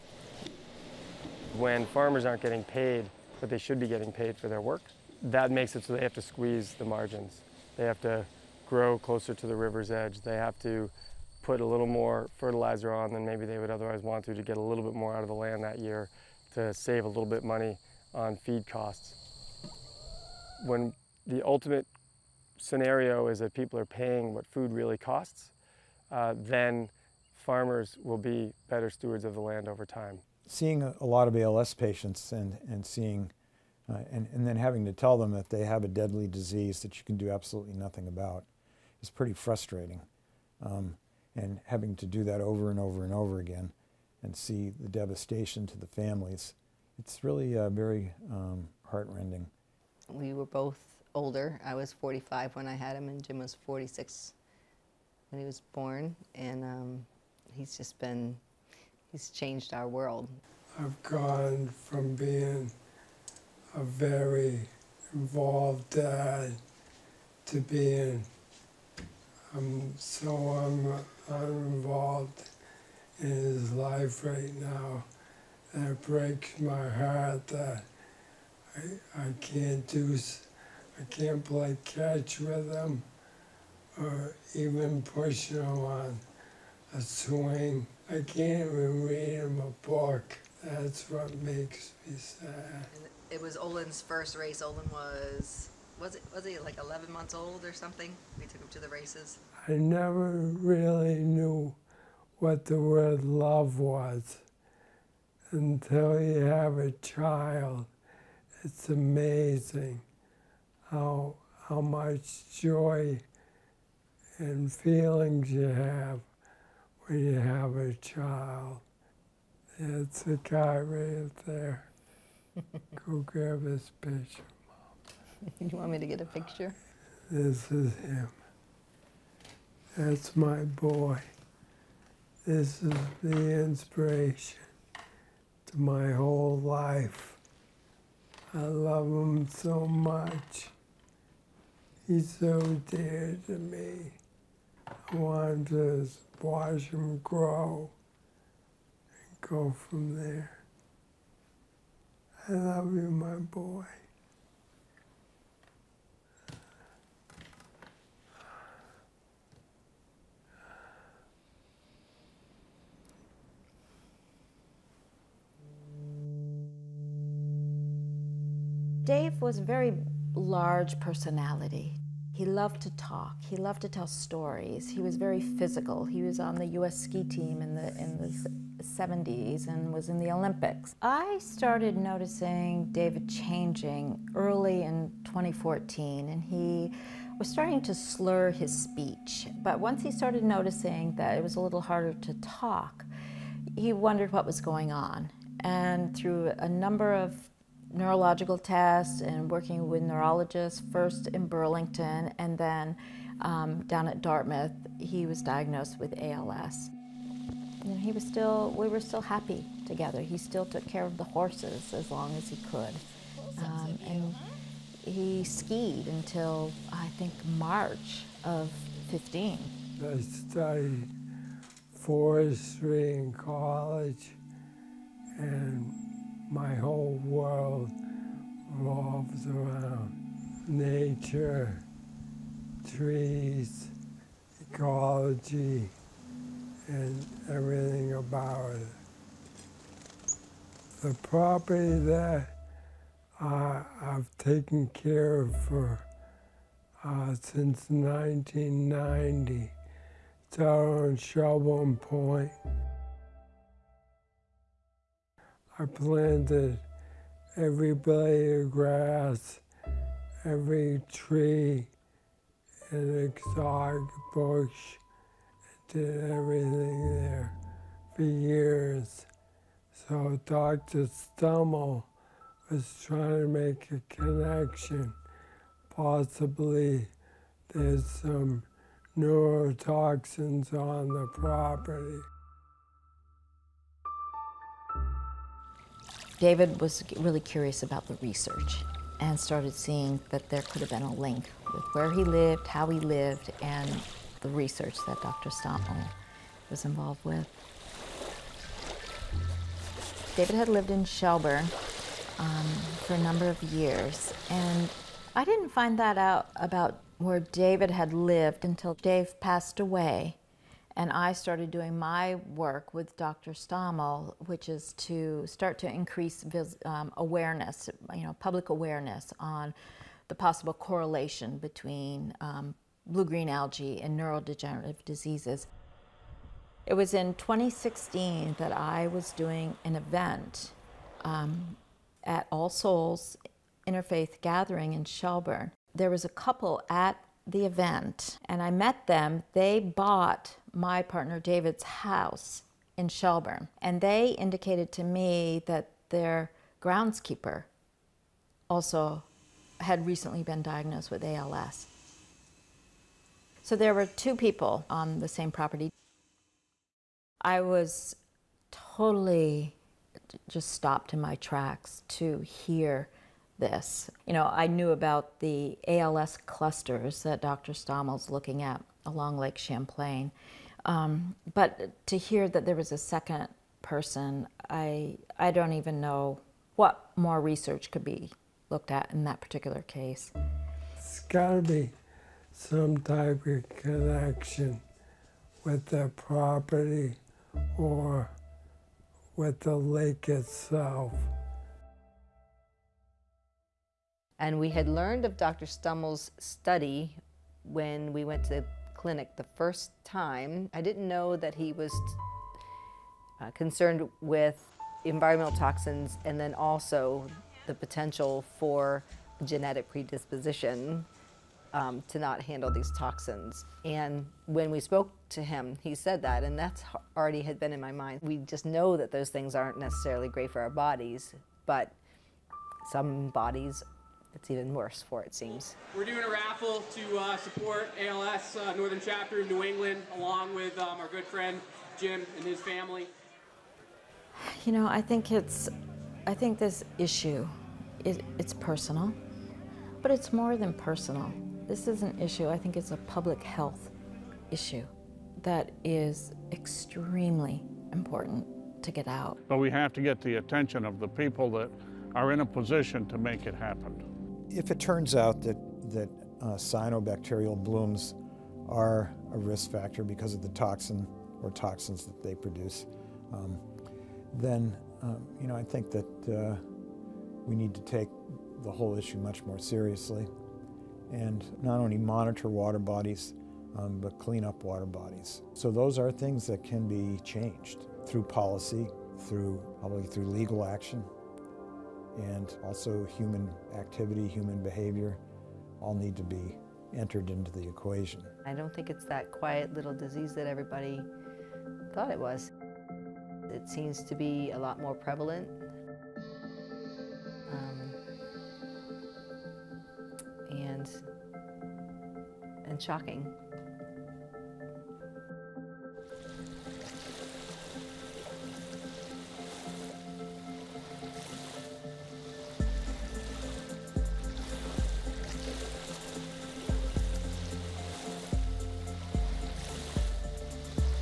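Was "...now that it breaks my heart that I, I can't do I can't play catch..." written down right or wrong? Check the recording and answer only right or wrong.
right.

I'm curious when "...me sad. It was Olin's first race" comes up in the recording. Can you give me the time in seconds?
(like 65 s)
92 s.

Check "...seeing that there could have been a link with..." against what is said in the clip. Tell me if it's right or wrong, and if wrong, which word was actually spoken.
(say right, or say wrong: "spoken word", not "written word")
right.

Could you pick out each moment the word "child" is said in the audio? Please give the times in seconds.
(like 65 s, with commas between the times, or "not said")
107 s, 117 s.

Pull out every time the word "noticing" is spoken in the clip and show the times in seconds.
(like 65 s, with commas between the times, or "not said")
181 s, 190 s.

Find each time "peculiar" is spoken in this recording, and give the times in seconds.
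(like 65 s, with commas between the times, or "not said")
not said.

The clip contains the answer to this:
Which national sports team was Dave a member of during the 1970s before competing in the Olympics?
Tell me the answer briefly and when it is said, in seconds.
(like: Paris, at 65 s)
U.S. ski team, at 176 s.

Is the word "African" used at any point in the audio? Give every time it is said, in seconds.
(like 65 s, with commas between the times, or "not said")
not said.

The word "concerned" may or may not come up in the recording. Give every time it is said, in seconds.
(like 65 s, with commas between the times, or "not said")
403 s.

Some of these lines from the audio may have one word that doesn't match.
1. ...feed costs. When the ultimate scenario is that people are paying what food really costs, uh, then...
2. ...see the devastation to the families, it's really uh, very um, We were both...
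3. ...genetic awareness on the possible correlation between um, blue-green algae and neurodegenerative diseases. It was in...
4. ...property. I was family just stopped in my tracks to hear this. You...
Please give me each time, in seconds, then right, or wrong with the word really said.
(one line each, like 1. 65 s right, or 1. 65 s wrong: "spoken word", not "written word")
1. 18 s right
2. 44 s right
3. 318 s wrong: "public", not "genetic"
4. 355 s wrong: "totally", not "family".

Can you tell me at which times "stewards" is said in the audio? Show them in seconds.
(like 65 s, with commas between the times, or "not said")
28 s.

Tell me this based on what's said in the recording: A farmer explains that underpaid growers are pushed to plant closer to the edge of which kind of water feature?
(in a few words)
river.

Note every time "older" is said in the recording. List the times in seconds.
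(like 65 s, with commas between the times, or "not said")
51 s.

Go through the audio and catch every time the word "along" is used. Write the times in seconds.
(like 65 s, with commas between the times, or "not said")
369 s, 430 s.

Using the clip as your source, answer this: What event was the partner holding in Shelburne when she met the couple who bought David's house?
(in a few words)
All Souls Interfaith Gathering.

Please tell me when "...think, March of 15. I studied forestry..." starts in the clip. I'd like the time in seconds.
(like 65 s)
217 s.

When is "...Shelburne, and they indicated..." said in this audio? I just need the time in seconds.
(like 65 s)
343 s.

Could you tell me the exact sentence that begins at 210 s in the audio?
He still took care of the horses as long as he could.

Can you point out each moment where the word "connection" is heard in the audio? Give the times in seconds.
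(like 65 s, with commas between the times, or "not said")
274 s, 383 s.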